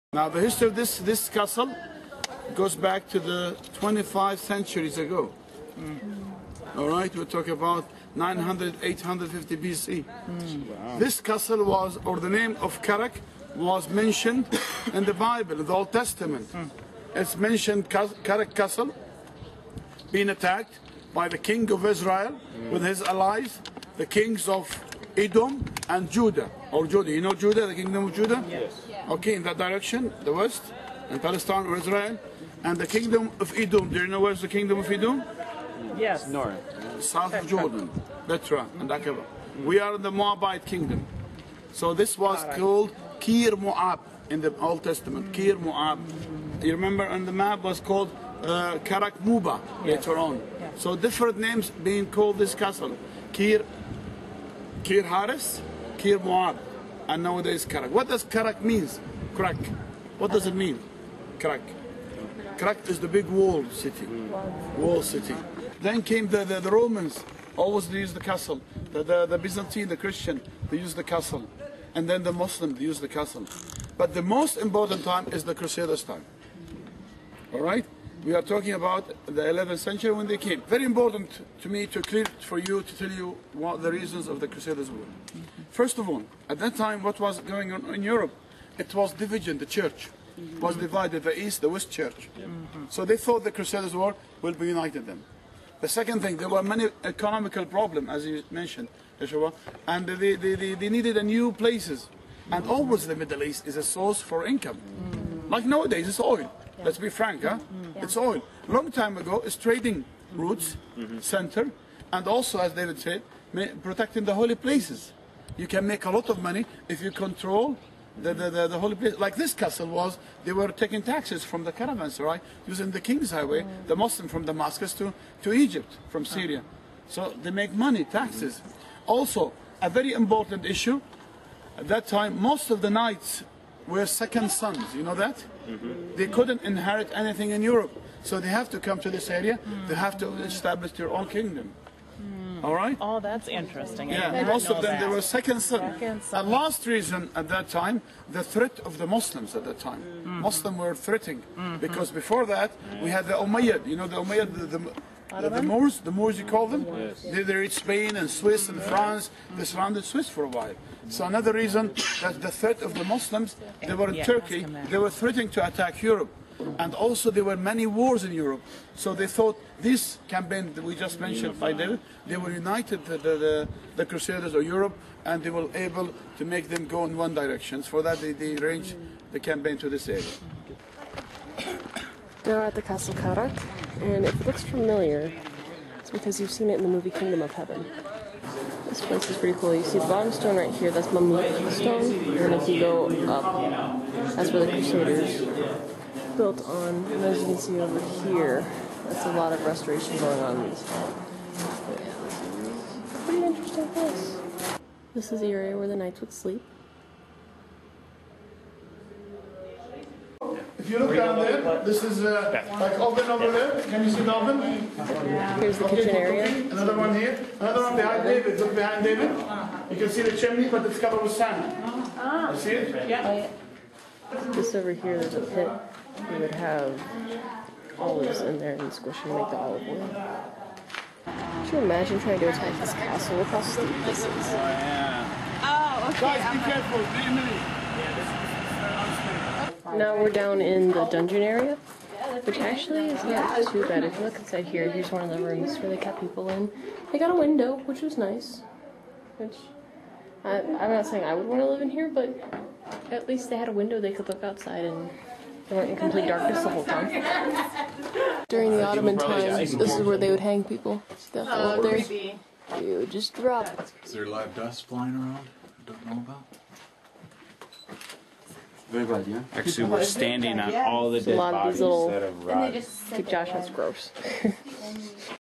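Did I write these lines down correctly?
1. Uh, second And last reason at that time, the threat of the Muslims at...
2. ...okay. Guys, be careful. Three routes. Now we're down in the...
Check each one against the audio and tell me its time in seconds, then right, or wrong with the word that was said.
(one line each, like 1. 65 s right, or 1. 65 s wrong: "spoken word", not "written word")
1. 145 s right
2. 236 s wrong: "minutes", not "routes".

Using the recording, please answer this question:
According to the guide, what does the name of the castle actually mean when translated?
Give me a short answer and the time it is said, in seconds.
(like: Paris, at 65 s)
Big wall city, at 62 s.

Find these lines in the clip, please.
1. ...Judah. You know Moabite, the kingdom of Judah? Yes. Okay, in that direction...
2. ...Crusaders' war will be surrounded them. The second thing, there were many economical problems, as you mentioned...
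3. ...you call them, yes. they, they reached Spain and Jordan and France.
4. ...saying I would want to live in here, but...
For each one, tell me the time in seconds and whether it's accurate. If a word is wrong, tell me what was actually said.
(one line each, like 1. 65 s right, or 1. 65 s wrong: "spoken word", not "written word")
1. 26 s wrong: "Judah", not "Moabite"
2. 93 s wrong: "united", not "surrounded"
3. 156 s wrong: "Swiss", not "Jordan"
4. 251 s right.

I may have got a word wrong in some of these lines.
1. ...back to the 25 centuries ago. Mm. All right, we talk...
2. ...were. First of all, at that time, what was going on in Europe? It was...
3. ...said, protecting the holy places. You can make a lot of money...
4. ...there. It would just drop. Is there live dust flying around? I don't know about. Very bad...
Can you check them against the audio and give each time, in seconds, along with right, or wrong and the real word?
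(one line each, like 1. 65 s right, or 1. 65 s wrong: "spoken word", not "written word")
1. 2 s right
2. 84 s right
3. 112 s right
4. 261 s right.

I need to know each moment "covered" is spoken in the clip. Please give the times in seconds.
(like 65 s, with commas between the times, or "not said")
220 s.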